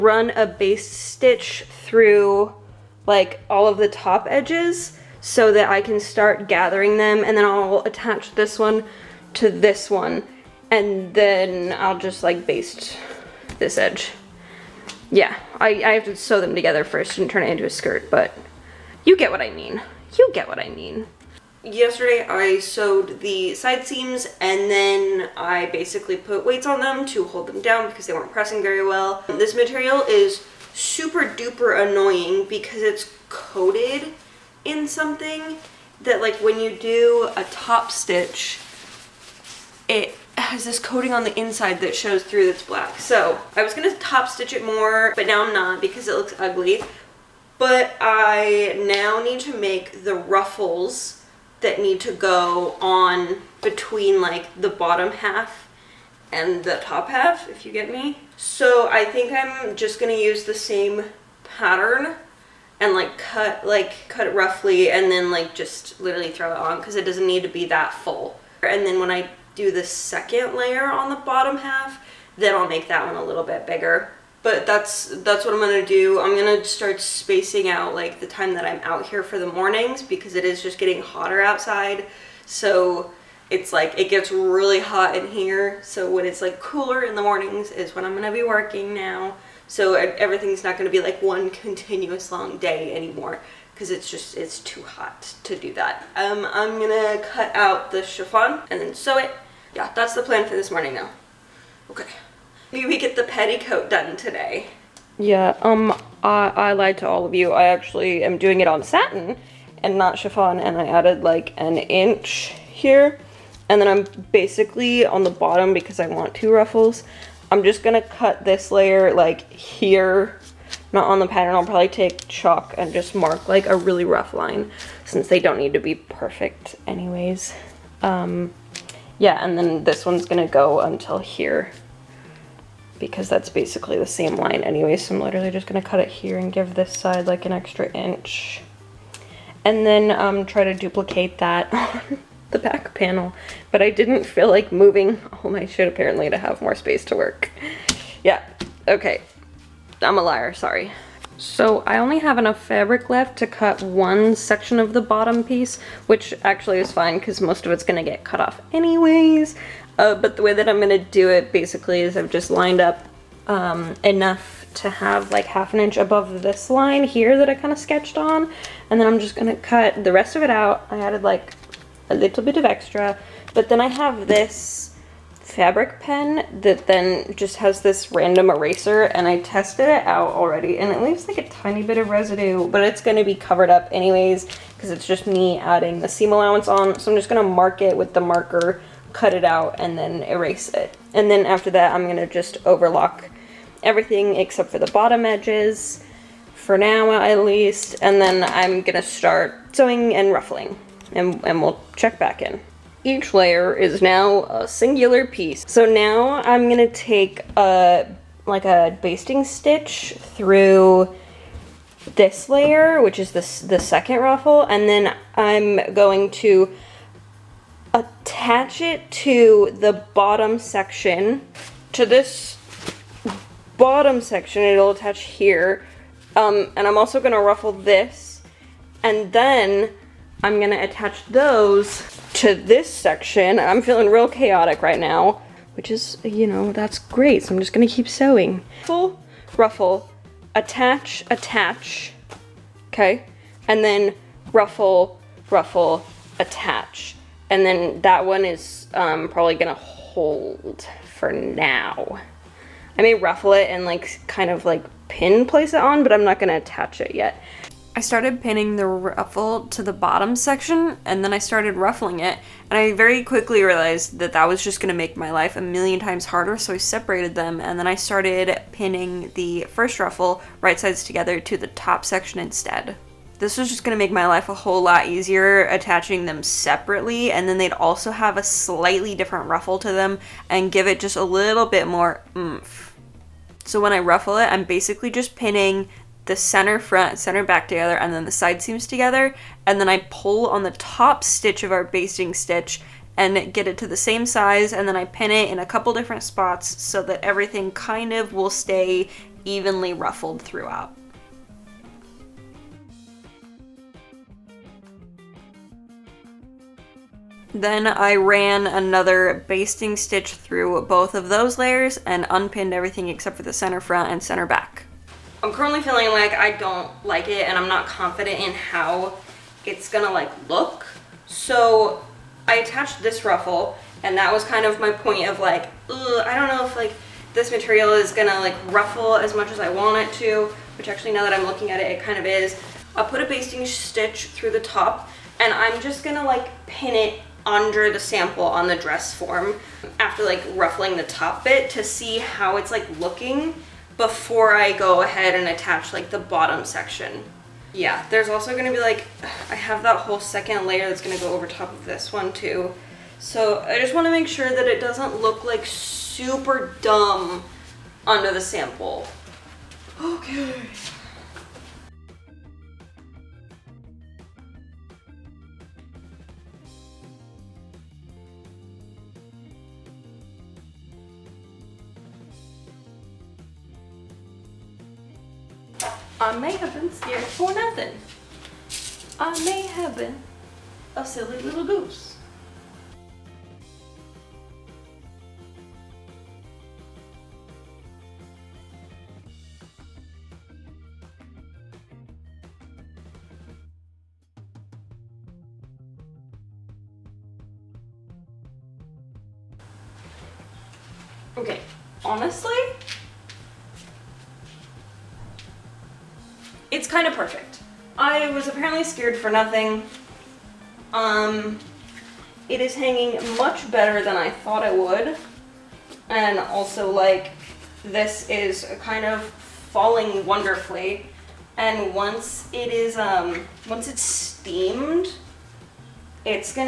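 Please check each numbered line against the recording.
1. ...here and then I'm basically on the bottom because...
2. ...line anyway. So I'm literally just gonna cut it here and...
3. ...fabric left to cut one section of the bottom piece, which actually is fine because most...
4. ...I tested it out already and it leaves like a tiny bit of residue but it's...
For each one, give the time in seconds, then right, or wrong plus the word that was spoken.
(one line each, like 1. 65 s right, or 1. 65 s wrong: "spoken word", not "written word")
1. 112 s right
2. 134 s right
3. 152 s right
4. 179 s right.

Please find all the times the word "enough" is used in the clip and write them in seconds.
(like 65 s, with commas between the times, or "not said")
152 s, 164 s.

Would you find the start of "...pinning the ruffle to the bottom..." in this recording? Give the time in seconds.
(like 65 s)
258 s.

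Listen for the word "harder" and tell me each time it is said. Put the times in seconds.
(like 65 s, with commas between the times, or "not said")
266 s.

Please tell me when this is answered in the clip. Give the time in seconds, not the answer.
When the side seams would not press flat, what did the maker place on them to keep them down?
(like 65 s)
26 s.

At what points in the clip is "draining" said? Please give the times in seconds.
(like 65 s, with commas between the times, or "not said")
not said.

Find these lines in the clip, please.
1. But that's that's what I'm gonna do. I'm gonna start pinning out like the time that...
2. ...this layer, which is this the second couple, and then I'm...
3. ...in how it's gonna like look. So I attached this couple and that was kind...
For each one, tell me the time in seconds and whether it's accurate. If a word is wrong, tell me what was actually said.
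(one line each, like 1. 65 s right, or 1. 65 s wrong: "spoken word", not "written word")
1. 74 s wrong: "spacing", not "pinning"
2. 212 s wrong: "ruffle", not "couple"
3. 318 s wrong: "ruffle", not "couple".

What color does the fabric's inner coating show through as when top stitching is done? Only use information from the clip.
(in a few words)
Black.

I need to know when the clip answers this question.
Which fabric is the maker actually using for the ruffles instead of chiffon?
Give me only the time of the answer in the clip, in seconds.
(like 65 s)
108 s.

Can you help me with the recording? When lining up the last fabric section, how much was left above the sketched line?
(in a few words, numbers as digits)
Half an inch.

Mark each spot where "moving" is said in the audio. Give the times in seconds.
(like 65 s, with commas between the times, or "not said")
144 s.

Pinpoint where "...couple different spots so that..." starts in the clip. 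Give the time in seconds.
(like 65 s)
295 s.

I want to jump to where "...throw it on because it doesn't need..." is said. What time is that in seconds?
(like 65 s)
66 s.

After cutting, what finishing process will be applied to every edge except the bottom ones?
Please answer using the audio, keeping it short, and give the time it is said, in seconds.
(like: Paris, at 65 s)
Overlock, at 192 s.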